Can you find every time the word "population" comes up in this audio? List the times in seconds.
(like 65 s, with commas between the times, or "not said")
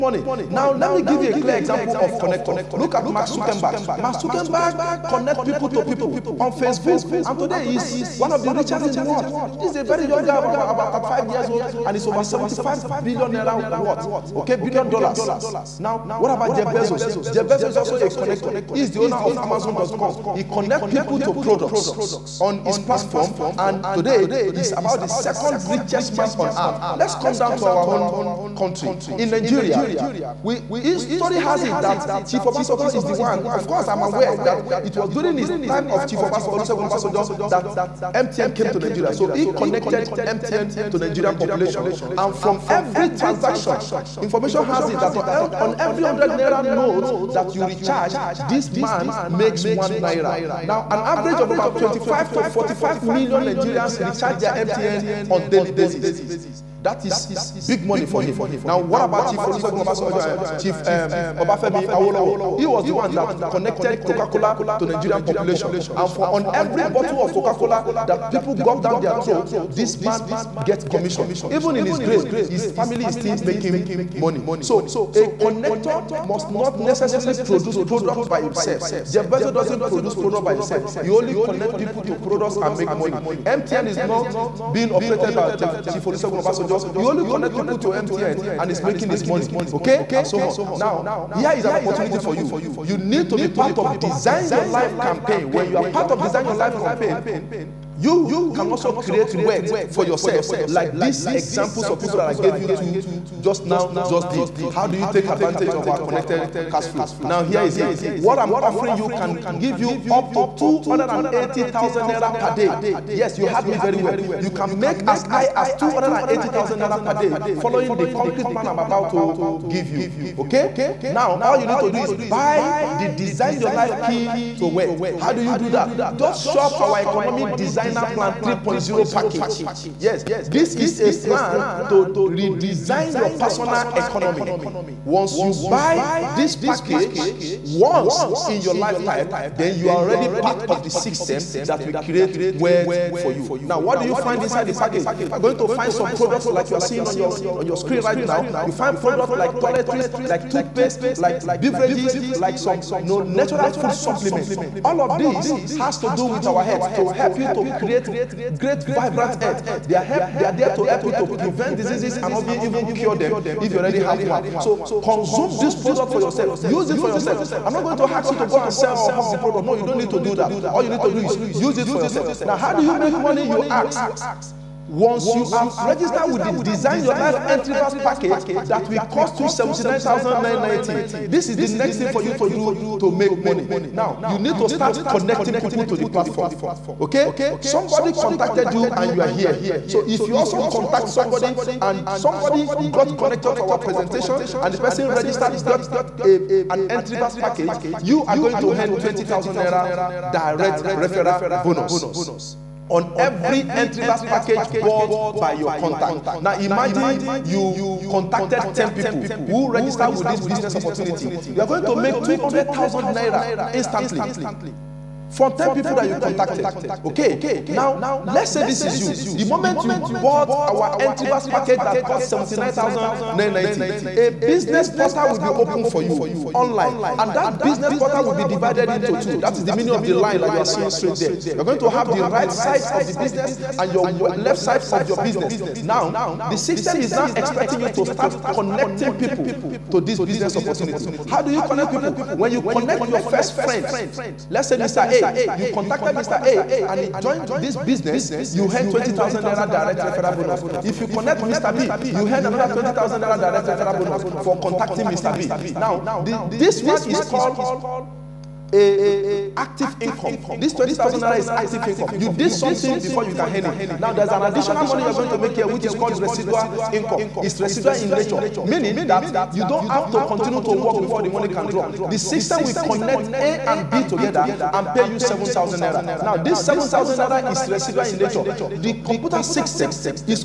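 41 s, 65 s.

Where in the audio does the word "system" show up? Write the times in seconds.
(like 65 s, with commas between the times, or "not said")
140 s, 236 s, 272 s, 279 s.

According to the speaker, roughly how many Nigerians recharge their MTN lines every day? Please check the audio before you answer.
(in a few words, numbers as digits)
25 to 45 million.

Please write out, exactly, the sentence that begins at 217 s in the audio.
Okay, now let's say this is you.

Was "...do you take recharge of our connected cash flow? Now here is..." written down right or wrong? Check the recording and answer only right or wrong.
wrong.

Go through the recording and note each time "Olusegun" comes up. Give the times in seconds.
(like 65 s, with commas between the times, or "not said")
59 s, 86 s.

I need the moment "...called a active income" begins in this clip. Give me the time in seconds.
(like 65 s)
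257 s.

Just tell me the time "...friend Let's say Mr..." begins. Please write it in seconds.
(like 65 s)
243 s.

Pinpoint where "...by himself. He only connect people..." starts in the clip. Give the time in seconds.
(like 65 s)
80 s.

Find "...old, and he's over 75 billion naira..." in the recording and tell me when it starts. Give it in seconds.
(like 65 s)
11 s.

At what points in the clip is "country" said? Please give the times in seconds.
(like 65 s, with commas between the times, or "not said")
28 s.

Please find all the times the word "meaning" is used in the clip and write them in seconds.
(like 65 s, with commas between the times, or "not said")
229 s, 268 s.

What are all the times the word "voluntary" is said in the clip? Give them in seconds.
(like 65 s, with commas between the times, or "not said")
not said.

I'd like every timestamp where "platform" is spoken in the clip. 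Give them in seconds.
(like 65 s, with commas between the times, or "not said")
22 s, 186 s.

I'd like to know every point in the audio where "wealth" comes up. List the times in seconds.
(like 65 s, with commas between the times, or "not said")
99 s, 142 s.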